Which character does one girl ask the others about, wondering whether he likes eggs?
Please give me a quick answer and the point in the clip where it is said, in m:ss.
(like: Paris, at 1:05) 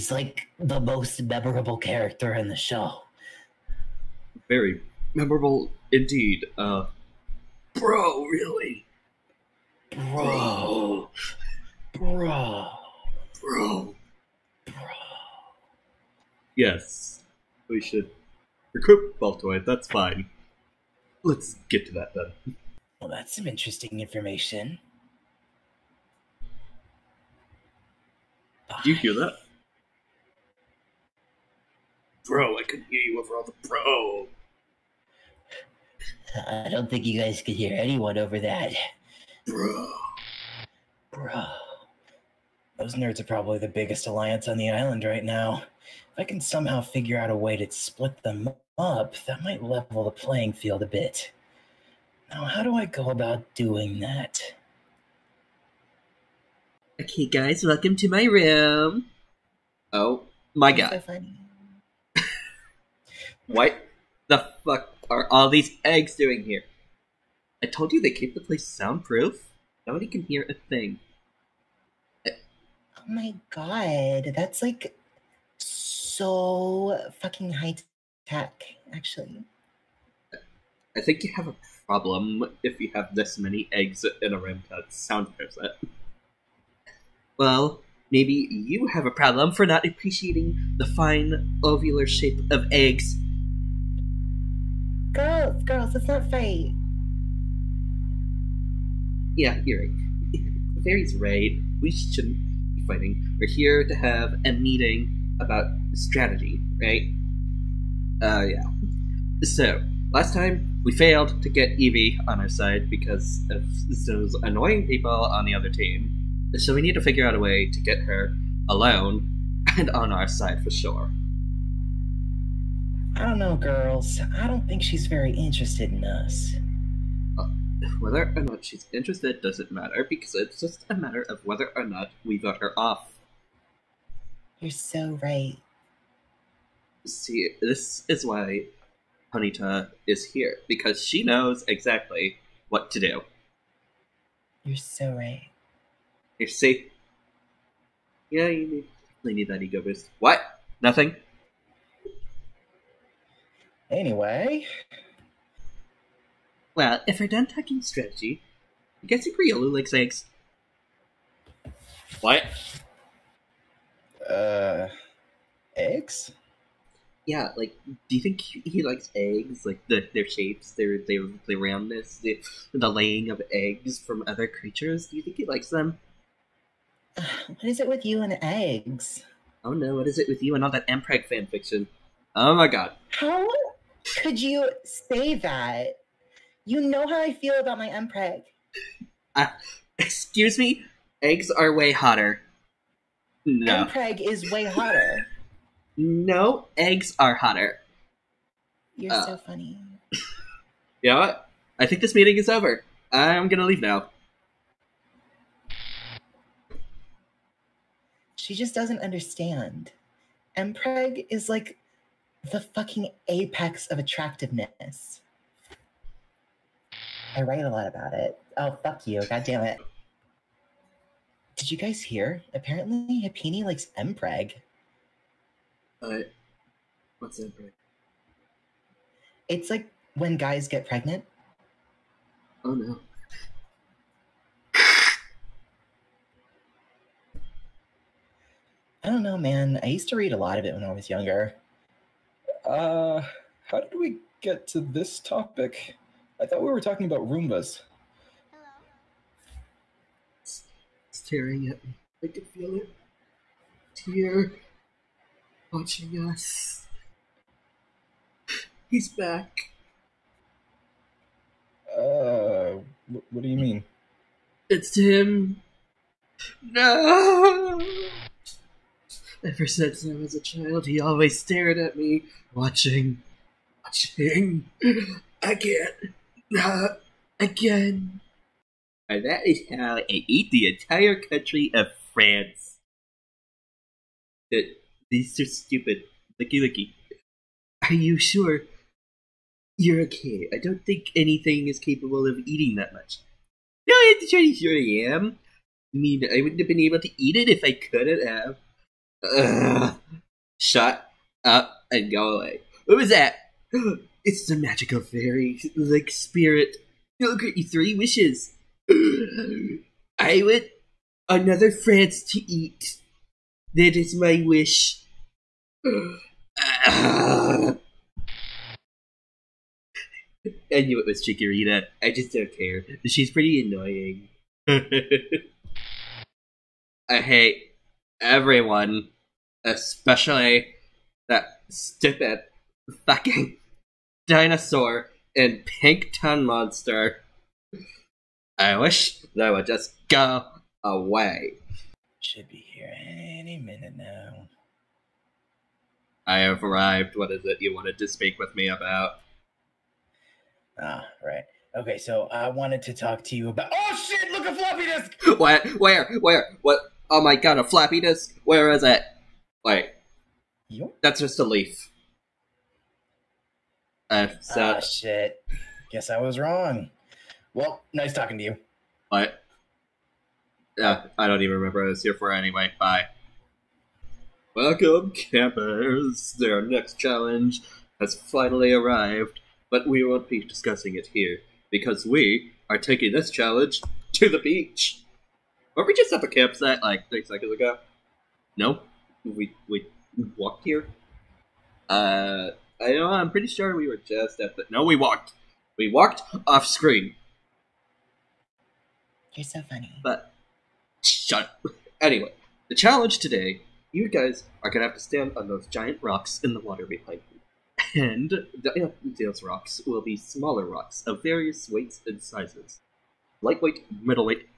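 Riolu, at 2:39.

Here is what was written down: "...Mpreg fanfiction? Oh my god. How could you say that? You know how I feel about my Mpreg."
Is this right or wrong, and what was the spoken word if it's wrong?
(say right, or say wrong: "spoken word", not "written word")
right.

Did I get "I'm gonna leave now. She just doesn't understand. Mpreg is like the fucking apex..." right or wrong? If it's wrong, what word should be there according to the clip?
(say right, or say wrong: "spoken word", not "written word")
right.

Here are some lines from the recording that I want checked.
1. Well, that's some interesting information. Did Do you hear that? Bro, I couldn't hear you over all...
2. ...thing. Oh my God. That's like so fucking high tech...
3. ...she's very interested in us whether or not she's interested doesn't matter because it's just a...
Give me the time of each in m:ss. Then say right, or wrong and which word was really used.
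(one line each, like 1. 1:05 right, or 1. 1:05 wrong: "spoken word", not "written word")
1. 0:22 right
2. 1:10 right
3. 2:04 right.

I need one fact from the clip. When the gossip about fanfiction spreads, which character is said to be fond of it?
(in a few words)
Happiny.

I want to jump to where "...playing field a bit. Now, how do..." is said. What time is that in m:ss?
0:50.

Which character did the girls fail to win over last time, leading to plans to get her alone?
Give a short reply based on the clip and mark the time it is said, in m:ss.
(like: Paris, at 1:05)
Eevee, at 1:51.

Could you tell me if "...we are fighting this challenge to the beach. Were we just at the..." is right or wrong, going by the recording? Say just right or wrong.
wrong.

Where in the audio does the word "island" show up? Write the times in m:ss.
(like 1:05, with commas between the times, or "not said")
0:44.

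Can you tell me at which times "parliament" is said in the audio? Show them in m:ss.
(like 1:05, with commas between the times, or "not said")
not said.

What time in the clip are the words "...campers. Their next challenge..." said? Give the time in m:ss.
6:15.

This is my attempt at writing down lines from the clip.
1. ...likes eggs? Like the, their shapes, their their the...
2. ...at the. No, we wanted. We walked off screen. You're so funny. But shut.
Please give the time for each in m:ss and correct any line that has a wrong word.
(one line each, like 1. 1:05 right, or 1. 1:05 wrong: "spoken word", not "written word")
1. 2:48 right
2. 6:34 wrong: "walked", not "wanted".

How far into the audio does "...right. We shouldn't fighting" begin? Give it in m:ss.
1:41.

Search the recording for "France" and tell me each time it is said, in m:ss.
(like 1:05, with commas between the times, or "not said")
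4:42, 5:11.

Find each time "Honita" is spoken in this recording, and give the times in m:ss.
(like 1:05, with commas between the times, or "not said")
2:19.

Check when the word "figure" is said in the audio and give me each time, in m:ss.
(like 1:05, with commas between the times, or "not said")
0:46, 1:57.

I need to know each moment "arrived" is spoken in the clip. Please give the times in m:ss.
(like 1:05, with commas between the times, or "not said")
5:46, 6:18.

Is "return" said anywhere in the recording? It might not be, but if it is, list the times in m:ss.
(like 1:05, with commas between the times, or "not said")
not said.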